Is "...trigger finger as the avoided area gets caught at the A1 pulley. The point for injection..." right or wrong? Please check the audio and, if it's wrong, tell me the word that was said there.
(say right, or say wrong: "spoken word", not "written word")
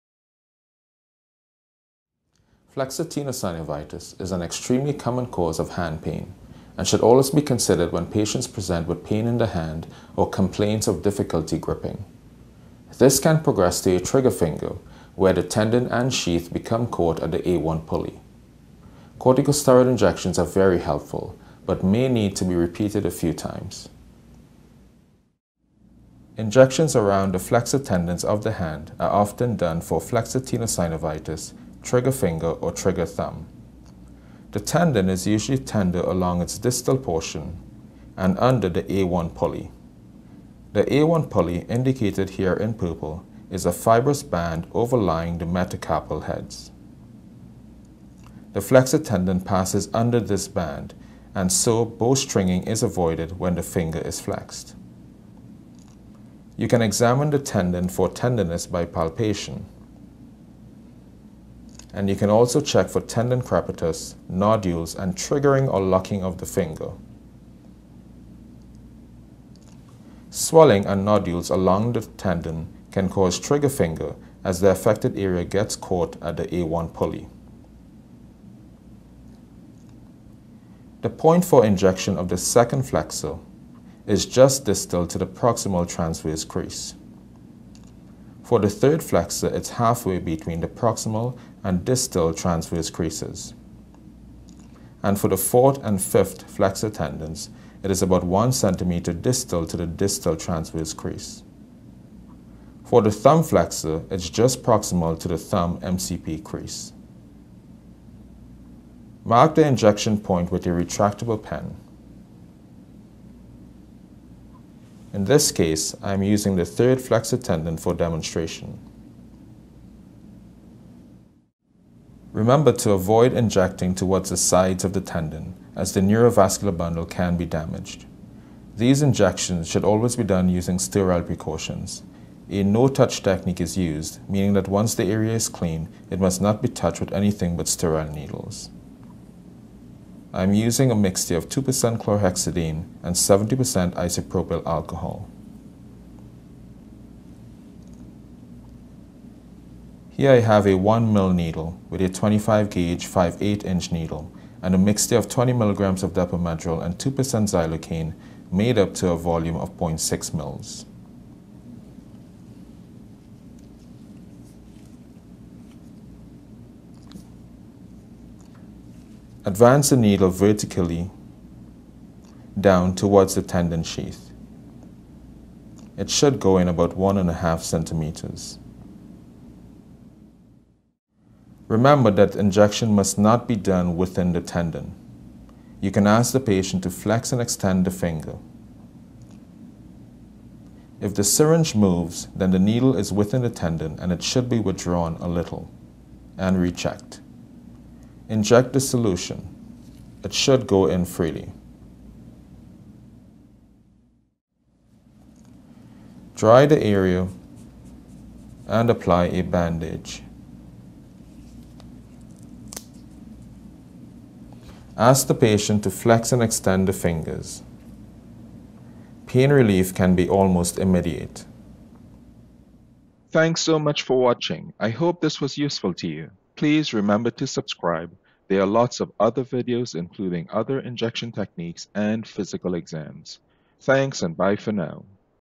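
wrong: "affected", not "avoided".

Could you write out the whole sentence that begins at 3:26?
Dry the area and apply a bandage.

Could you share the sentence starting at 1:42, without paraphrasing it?
For the thumb flexor, it's just proximal to the thumb MCP crease.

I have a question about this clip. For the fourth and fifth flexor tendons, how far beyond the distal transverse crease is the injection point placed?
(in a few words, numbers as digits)
1 centimeter.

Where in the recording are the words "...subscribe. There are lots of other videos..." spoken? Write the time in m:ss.
3:47.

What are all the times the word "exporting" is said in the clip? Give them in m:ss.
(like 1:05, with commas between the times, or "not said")
not said.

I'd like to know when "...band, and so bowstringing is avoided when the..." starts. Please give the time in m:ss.
0:50.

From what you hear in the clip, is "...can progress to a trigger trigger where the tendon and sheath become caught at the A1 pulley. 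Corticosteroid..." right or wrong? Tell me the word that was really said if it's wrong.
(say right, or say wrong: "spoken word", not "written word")
wrong: "finger", not "trigger".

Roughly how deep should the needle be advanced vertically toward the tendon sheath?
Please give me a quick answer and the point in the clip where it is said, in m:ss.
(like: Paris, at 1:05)
1.5 centimeters, at 2:56.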